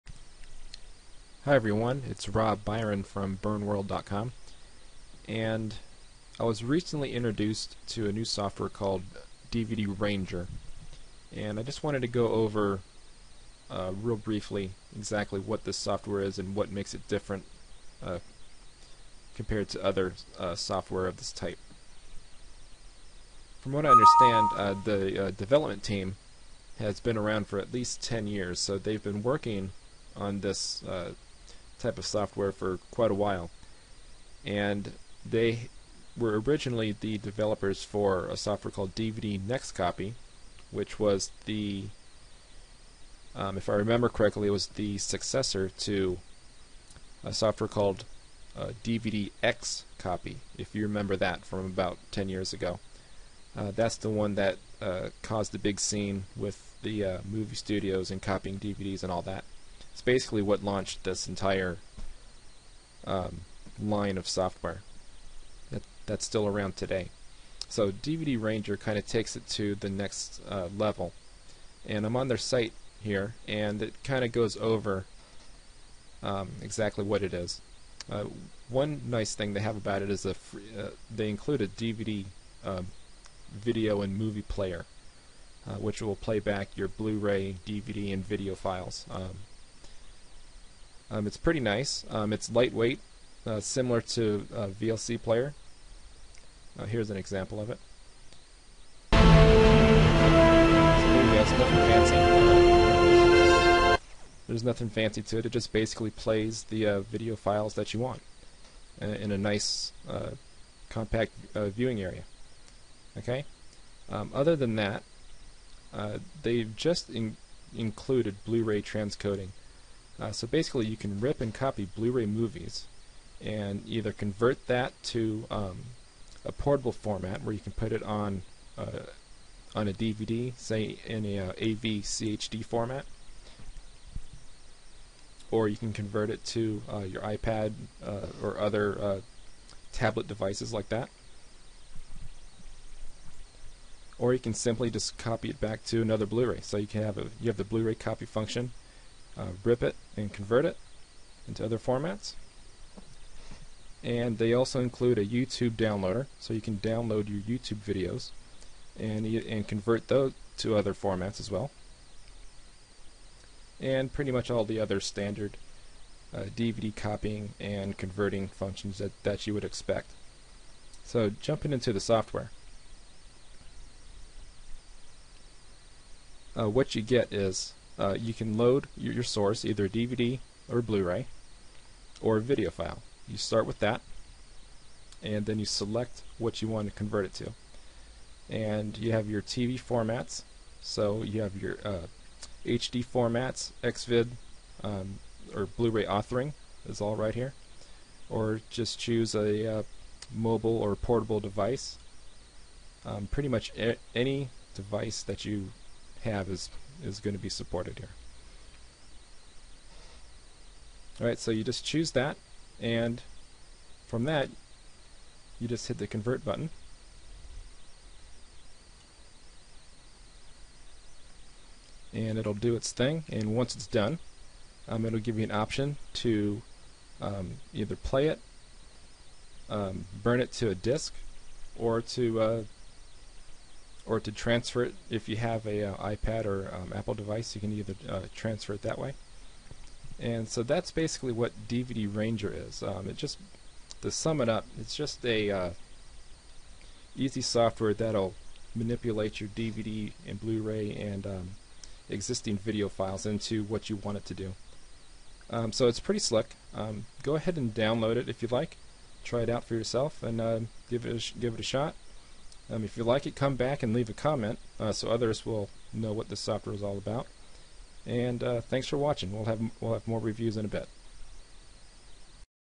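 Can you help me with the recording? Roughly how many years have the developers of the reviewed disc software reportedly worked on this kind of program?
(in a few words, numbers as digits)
10.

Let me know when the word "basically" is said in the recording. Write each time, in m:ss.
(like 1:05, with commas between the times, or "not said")
1:00, 1:45, 2:00, 4:00.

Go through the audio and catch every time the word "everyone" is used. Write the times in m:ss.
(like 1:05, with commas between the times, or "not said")
0:01.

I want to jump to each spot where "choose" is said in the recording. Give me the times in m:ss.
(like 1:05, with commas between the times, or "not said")
3:18, 3:31.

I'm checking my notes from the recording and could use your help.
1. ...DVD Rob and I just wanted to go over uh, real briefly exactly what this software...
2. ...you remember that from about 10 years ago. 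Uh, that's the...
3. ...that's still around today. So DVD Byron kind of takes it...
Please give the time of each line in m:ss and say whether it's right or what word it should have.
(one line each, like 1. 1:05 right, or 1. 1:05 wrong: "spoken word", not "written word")
1. 0:09 wrong: "Ranger", not "Rob"
2. 0:50 right
3. 1:06 wrong: "Ranger", not "Byron".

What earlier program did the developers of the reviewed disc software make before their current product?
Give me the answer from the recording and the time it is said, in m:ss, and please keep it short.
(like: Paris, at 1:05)
DVD Next Copy, at 0:38.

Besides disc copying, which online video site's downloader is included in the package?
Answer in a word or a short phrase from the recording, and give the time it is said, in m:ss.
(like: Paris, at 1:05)
YouTube downloader, at 2:35.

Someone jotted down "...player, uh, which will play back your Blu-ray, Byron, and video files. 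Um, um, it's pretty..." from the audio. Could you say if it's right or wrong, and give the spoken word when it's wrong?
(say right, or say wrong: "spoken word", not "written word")
wrong: "DVD", not "Byron".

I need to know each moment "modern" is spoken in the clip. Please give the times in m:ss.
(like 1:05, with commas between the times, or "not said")
not said.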